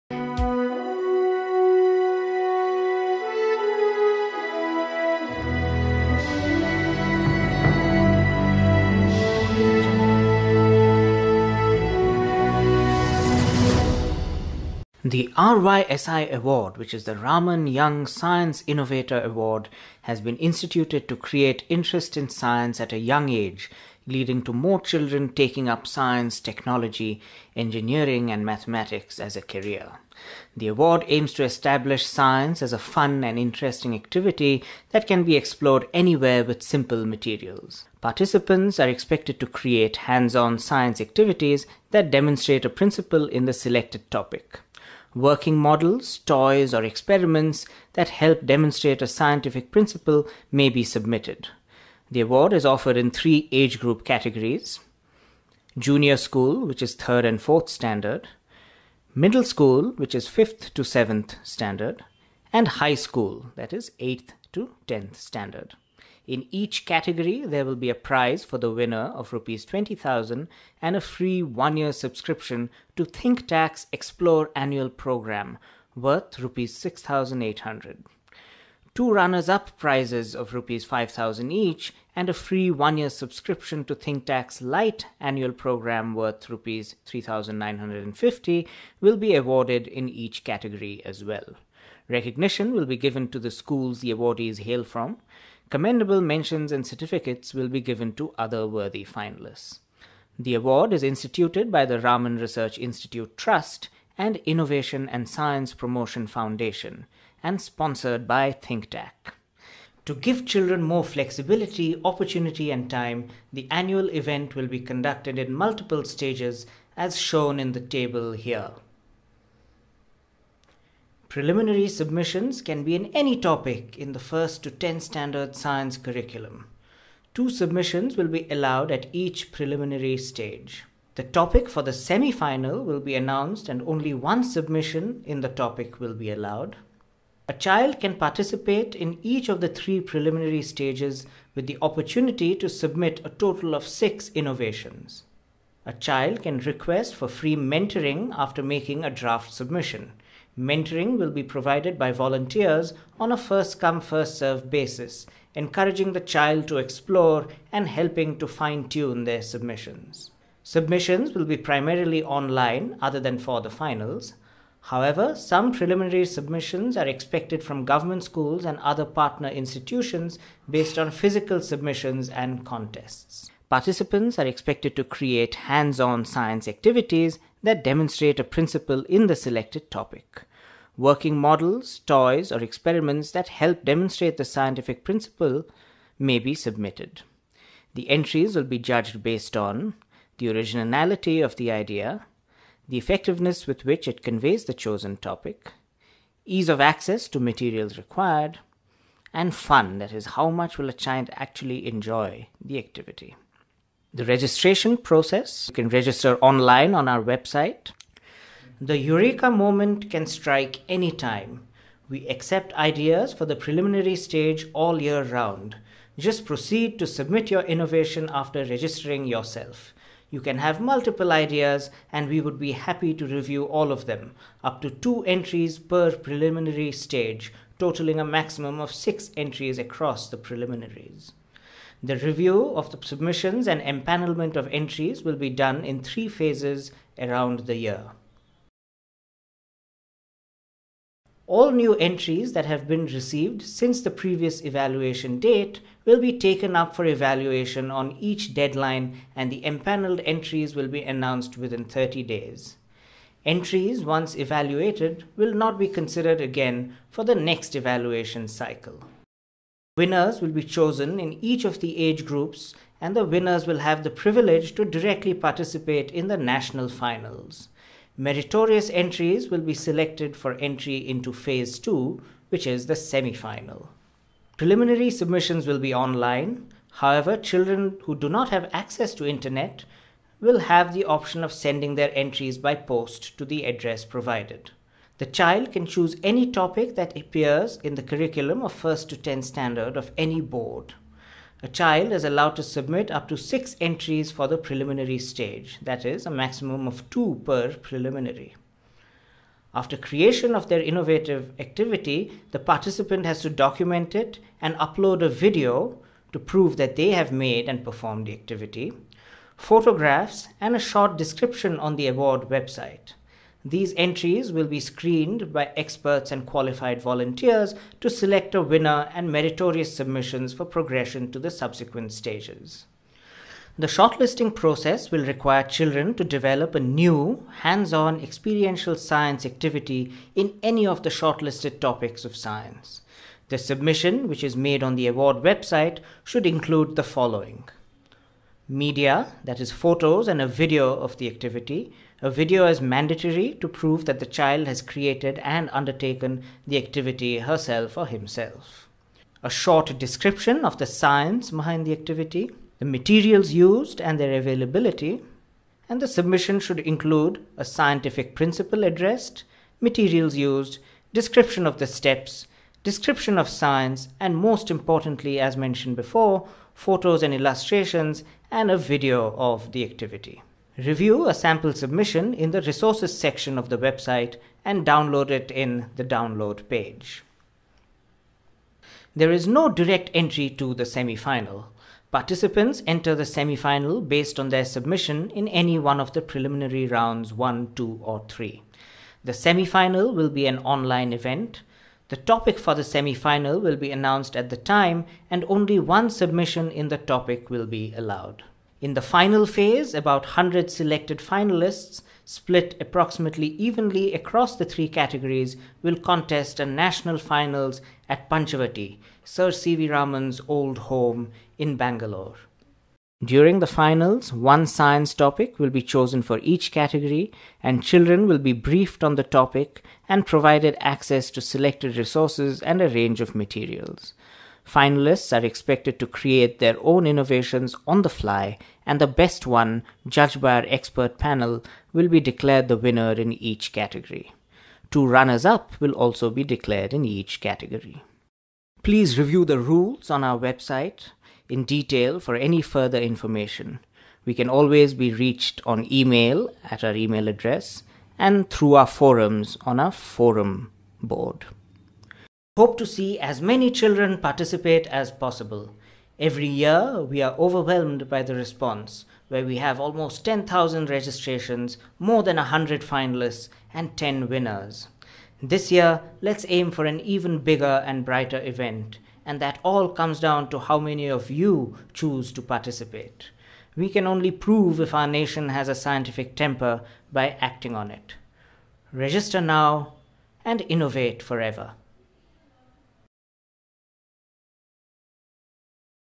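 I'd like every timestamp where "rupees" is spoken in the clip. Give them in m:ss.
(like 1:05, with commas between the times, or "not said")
1:09, 1:16, 1:20, 1:26.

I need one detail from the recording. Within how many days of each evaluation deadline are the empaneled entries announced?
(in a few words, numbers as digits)
30 days.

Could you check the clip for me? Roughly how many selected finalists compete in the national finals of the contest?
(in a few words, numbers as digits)
About 100.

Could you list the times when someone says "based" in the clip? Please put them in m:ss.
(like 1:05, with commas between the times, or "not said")
2:50, 3:09, 6:24.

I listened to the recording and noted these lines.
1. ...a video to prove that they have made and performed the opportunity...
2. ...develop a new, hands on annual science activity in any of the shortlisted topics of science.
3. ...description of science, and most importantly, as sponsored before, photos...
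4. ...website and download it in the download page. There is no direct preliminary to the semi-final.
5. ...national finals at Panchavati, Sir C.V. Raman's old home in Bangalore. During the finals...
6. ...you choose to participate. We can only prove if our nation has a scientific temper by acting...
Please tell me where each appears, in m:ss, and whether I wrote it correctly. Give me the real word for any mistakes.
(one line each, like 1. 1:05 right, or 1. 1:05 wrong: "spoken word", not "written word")
1. 5:05 wrong: "activity", not "opportunity"
2. 5:26 wrong: "experiential", not "annual"
3. 6:02 wrong: "mentioned", not "sponsored"
4. 6:13 wrong: "entry", not "preliminary"
5. 6:46 right
6. 7:51 right.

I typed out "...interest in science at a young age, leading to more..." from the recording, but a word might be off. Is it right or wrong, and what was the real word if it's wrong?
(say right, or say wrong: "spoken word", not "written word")
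right.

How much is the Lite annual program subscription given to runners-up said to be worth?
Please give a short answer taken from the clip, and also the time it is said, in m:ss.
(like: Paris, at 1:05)
Rs 3,950, at 1:26.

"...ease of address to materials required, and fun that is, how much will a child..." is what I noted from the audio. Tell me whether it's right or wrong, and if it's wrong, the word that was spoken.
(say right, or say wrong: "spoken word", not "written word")
wrong: "access", not "address".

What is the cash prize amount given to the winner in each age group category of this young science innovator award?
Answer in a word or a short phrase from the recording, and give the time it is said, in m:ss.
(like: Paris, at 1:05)
Rs 20,000, at 1:09.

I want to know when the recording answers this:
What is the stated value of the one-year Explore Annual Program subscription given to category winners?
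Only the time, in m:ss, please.
1:16.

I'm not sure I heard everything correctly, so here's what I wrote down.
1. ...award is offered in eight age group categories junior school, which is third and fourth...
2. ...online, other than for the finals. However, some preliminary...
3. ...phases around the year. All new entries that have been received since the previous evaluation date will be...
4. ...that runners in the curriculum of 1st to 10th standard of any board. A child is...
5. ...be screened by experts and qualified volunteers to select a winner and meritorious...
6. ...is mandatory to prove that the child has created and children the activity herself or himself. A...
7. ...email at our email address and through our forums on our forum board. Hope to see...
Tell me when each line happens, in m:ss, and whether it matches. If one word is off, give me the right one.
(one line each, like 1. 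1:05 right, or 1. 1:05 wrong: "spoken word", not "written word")
1. 0:52 wrong: "three", not "eight"
2. 2:42 right
3. 3:56 right
4. 4:46 wrong: "appears", not "runners"
5. 5:14 right
6. 5:42 wrong: "undertaken", not "children"
7. 7:25 right.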